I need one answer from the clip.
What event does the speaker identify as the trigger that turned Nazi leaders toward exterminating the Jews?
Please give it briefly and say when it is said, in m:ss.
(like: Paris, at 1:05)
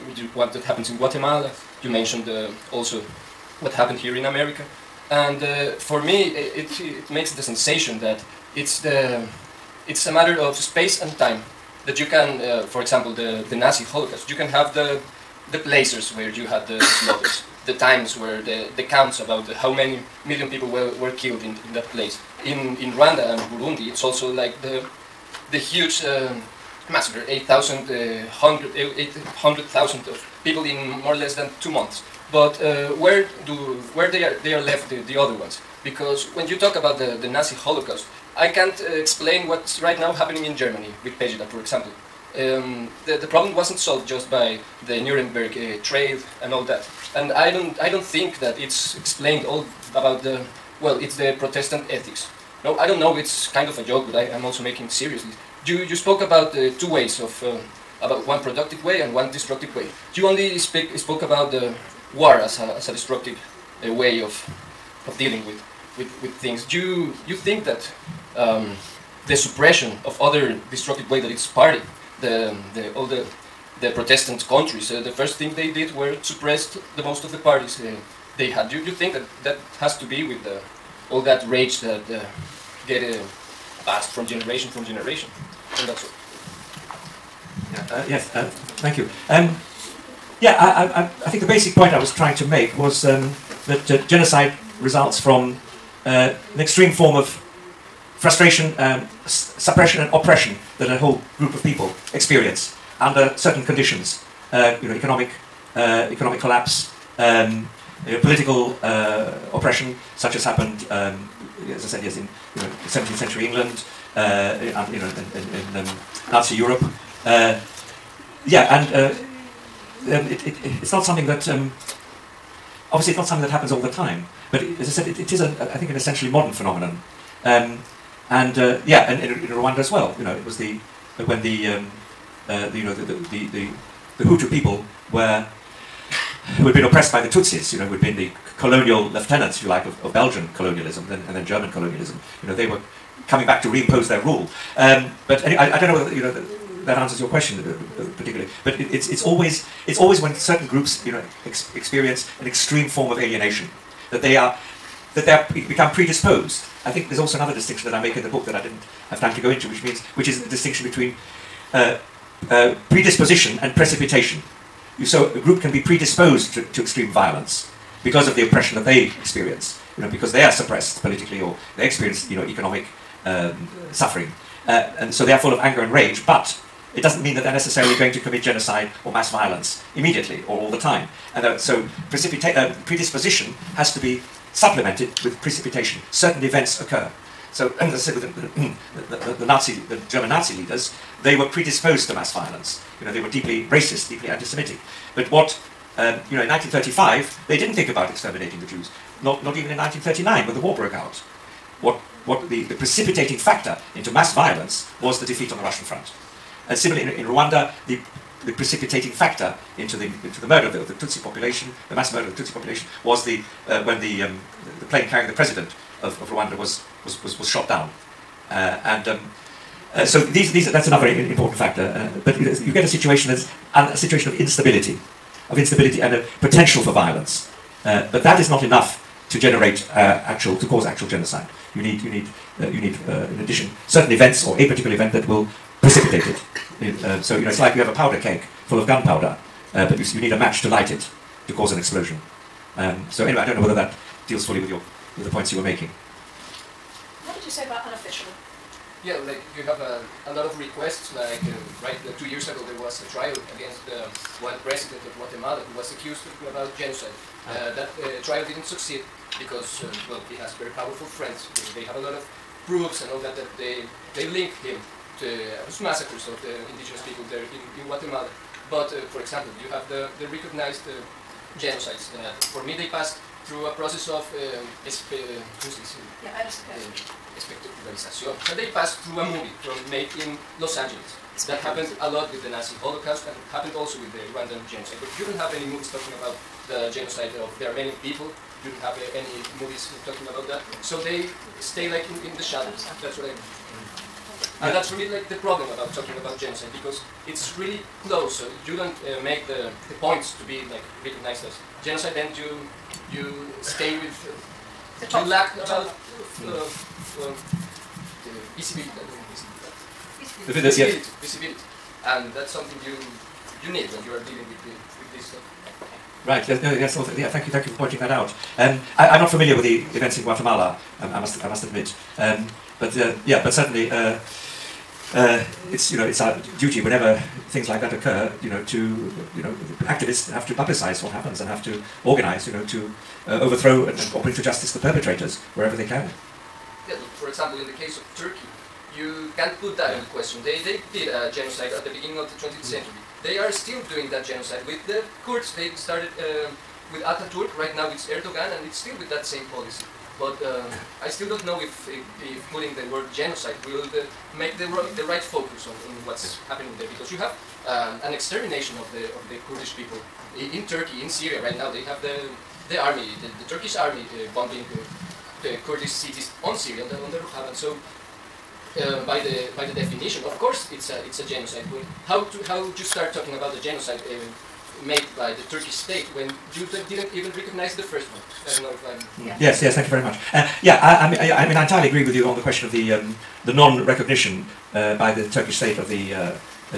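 defeat on the Russian front, at 3:25.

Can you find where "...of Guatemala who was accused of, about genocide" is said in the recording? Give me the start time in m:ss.
4:15.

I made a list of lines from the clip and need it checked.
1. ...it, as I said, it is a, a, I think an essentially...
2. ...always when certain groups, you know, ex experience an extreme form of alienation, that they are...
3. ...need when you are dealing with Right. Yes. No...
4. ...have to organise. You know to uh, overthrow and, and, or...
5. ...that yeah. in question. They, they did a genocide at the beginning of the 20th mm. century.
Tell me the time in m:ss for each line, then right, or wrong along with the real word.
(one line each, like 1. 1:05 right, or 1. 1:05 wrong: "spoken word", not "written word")
1. 2:04 right
2. 2:29 right
3. 5:13 right
4. 5:31 right
5. 5:39 right.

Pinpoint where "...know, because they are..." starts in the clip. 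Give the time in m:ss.
2:50.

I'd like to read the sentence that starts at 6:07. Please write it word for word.
So, uh, by the by the definition, of course, it's a it's a genocide.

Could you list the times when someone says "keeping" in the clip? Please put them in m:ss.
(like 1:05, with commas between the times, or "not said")
not said.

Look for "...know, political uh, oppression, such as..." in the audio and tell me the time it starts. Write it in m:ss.
1:48.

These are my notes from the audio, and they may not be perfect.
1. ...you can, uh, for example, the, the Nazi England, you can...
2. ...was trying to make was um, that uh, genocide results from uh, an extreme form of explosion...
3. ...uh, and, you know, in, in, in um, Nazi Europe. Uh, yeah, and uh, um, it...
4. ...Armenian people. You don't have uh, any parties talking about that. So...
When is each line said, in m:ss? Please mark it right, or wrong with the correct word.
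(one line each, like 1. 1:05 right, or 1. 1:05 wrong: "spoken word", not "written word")
1. 0:11 wrong: "Holocaust", not "England"
2. 1:31 wrong: "frustration", not "explosion"
3. 1:54 right
4. 4:47 wrong: "movies", not "parties".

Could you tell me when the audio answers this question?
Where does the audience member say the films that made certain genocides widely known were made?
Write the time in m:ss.
4:40.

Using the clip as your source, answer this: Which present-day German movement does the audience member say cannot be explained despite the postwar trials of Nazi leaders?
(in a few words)
Pegida.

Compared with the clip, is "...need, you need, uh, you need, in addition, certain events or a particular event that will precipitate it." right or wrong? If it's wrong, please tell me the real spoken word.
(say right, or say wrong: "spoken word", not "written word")
right.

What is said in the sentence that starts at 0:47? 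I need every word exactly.
And I don't, I don't think that it's explained all about the, well, it's the Protestant ethics.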